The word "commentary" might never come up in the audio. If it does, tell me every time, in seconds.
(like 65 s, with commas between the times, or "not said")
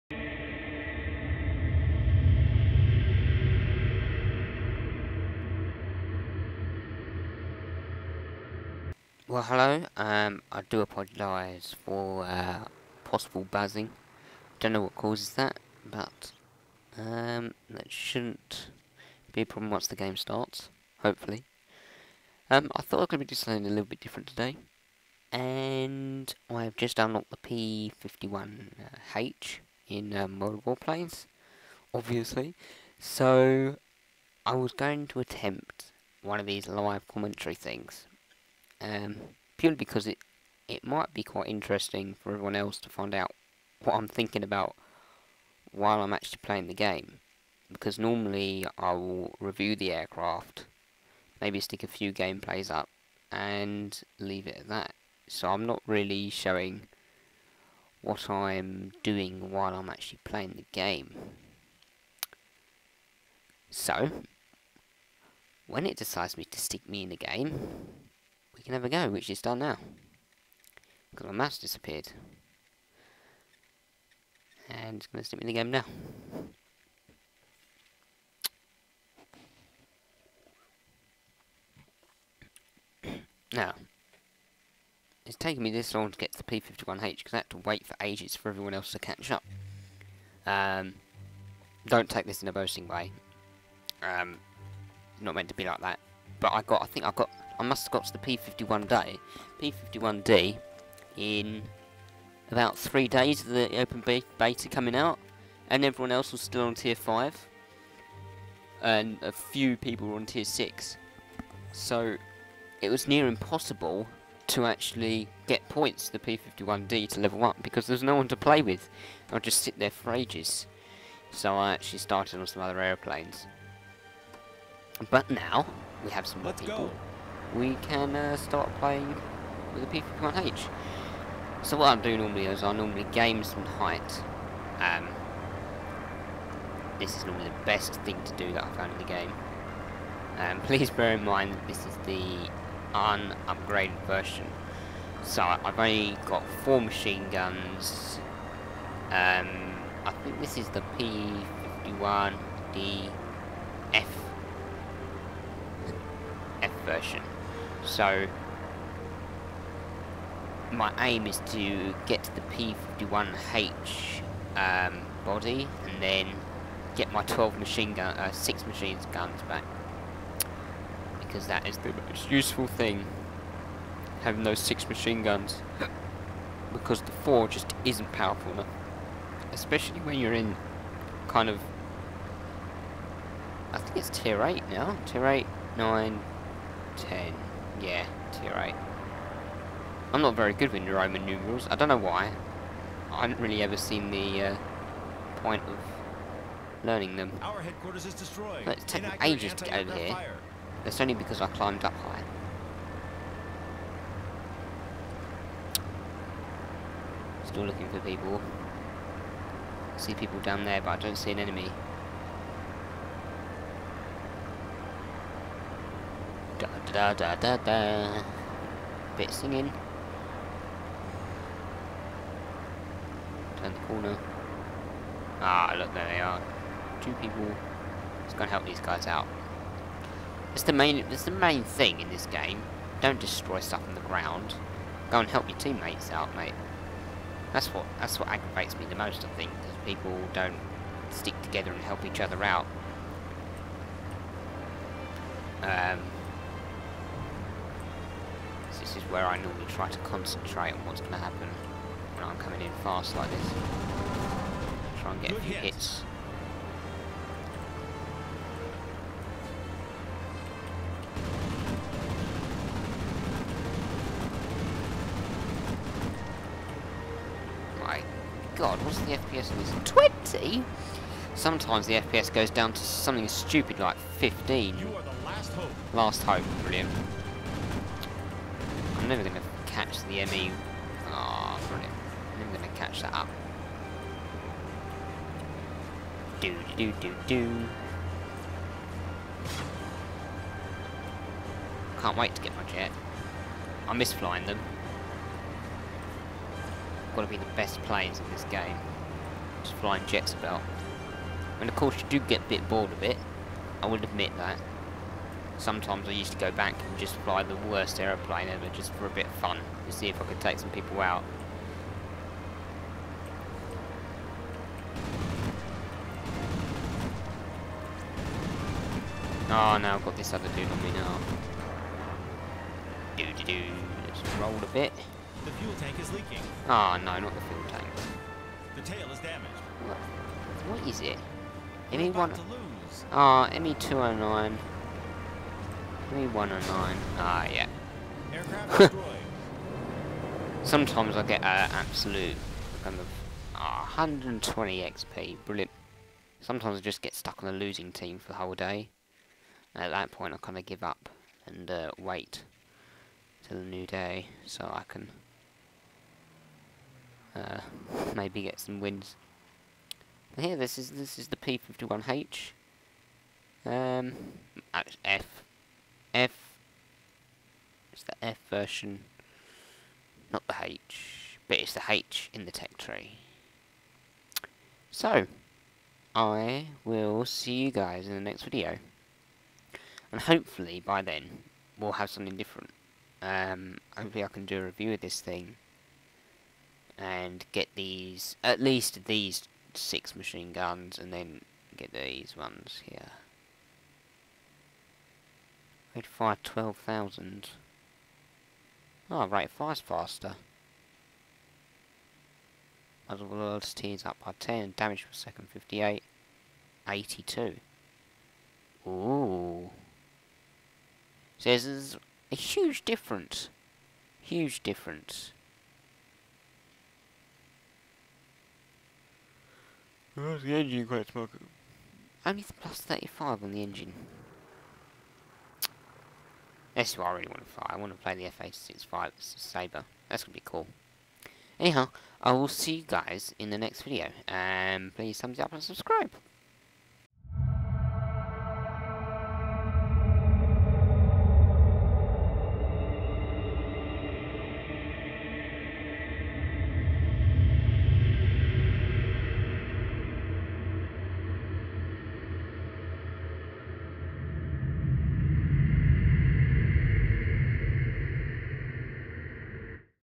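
37 s.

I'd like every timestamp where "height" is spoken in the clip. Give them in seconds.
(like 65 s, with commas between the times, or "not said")
133 s.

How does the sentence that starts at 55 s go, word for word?
So I'm not really showing what I'm doing while I'm actually playing the game.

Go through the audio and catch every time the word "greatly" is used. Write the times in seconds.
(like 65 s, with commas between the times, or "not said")
not said.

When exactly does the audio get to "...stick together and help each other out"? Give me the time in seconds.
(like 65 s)
241 s.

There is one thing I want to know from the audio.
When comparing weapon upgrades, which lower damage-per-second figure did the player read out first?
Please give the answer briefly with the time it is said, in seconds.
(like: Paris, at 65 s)
58, at 405 s.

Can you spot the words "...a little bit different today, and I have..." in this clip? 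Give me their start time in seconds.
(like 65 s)
23 s.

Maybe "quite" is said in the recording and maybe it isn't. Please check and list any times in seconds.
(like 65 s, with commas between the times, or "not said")
41 s, 420 s.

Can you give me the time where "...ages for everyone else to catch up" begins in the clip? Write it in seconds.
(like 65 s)
87 s.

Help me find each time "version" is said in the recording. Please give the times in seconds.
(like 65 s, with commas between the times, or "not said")
144 s, 156 s, 368 s.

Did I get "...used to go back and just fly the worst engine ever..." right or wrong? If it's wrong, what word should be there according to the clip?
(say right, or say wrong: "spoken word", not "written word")
wrong: "aeroplane", not "engine".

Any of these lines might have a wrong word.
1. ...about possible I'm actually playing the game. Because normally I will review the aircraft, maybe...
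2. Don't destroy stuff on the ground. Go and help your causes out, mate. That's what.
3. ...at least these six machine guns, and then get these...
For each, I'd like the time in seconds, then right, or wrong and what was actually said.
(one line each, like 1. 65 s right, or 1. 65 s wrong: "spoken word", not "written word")
1. 44 s wrong: "while", not "possible"
2. 233 s wrong: "teammates", not "causes"
3. 388 s right.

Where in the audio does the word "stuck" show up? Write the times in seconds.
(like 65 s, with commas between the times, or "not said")
347 s.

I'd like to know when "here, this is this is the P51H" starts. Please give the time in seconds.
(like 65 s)
360 s.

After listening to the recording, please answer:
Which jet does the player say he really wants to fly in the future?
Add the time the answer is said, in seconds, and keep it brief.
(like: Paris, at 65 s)
FA65 Sabre, at 428 s.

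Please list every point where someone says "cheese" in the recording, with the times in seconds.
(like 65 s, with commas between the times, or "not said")
not said.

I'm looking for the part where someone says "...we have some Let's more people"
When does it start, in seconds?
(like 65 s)
126 s.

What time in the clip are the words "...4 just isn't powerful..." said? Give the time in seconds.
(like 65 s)
177 s.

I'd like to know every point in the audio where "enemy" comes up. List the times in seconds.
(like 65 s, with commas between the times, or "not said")
211 s.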